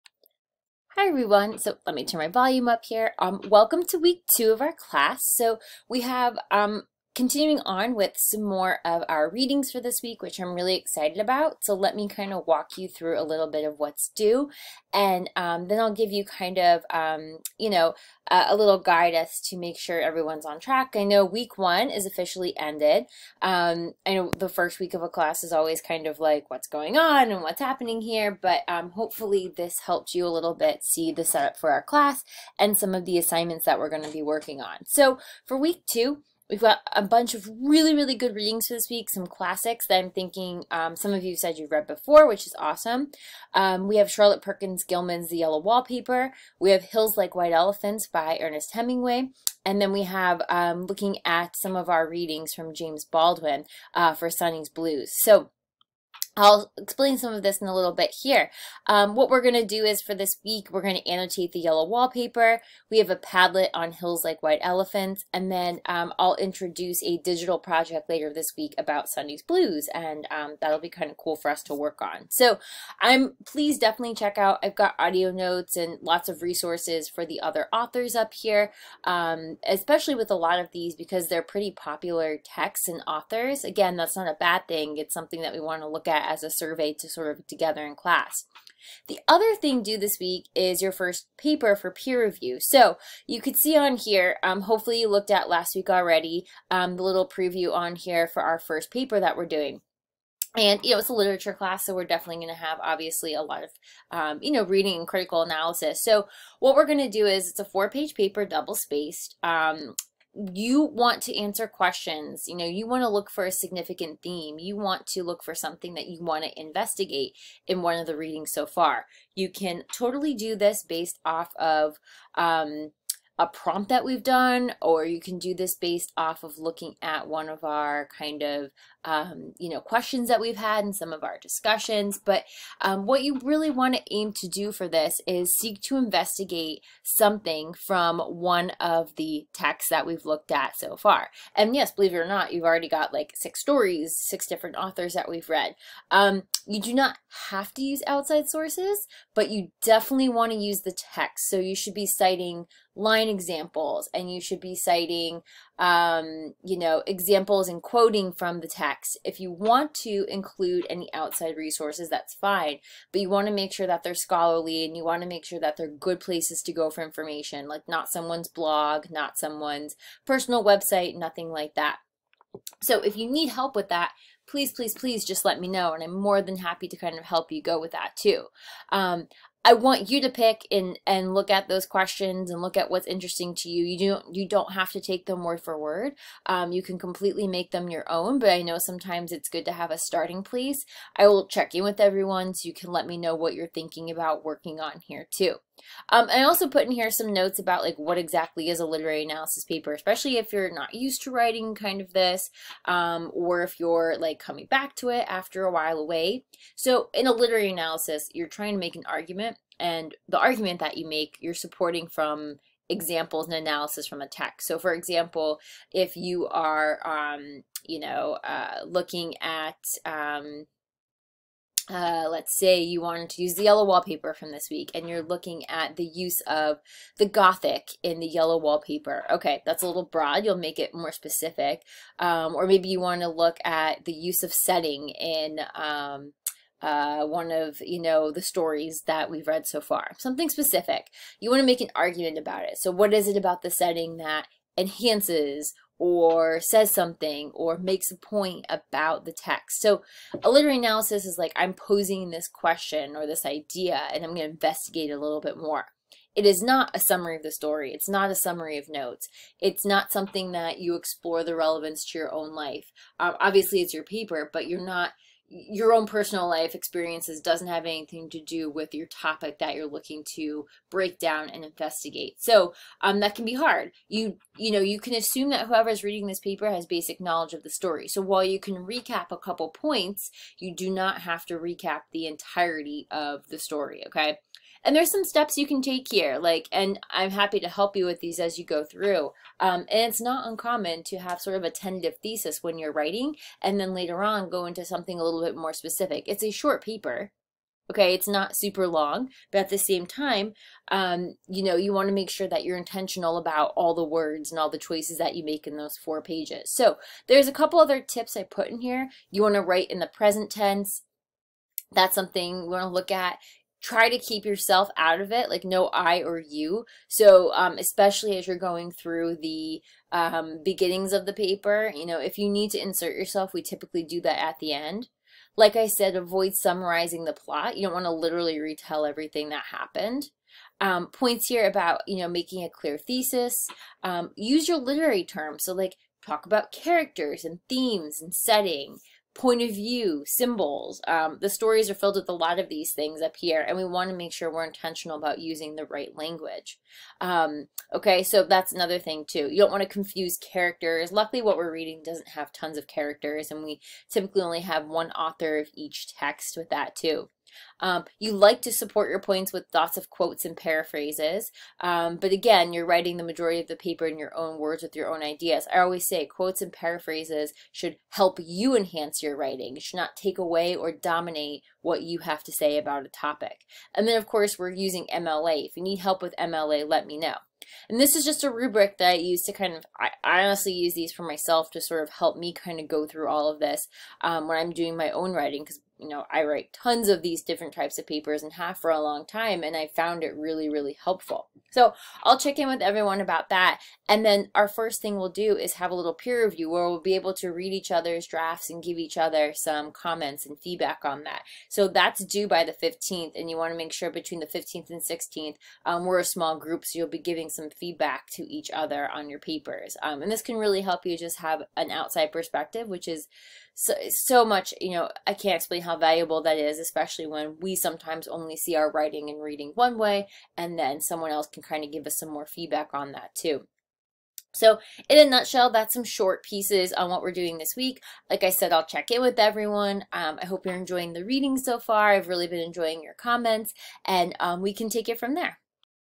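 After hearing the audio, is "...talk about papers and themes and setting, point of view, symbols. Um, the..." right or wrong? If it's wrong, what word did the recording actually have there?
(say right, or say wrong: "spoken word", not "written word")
wrong: "characters", not "papers".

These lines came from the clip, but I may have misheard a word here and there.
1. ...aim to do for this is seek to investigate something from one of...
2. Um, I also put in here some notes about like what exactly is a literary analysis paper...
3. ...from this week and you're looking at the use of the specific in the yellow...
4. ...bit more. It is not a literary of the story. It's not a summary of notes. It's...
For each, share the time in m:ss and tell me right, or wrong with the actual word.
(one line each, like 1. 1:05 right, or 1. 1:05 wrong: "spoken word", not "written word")
1. 2:14 right
2. 3:16 right
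3. 3:44 wrong: "gothic", not "specific"
4. 4:15 wrong: "summary", not "literary".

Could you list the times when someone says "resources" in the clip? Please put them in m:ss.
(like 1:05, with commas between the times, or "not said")
1:16, 2:41.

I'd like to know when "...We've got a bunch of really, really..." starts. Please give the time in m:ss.
0:36.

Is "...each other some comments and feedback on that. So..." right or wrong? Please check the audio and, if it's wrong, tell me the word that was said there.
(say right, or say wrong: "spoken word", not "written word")
right.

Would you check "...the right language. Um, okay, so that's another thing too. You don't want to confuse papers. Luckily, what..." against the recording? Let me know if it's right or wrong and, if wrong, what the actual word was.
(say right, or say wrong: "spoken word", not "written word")
wrong: "characters", not "papers".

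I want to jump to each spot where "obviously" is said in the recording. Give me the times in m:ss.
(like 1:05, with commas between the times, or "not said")
1:42, 4:23.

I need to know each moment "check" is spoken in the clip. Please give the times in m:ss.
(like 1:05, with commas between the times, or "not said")
1:14, 3:11, 6:32, 7:08.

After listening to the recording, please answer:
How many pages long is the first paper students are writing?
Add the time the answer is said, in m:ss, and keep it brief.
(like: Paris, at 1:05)
4, at 1:47.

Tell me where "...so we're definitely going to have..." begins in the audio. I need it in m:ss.
1:41.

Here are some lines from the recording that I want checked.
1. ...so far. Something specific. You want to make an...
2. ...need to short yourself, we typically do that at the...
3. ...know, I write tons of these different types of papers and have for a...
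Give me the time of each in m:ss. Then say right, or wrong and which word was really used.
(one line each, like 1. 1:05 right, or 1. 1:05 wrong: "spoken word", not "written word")
1. 3:59 right
2. 5:22 wrong: "insert", not "short"
3. 6:26 right.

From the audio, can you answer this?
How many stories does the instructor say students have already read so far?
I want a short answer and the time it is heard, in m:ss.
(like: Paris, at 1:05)
6, at 2:23.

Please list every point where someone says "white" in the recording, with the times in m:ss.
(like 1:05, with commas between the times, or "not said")
0:47, 1:04.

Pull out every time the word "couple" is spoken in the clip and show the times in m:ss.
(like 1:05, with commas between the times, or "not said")
4:39, 5:07.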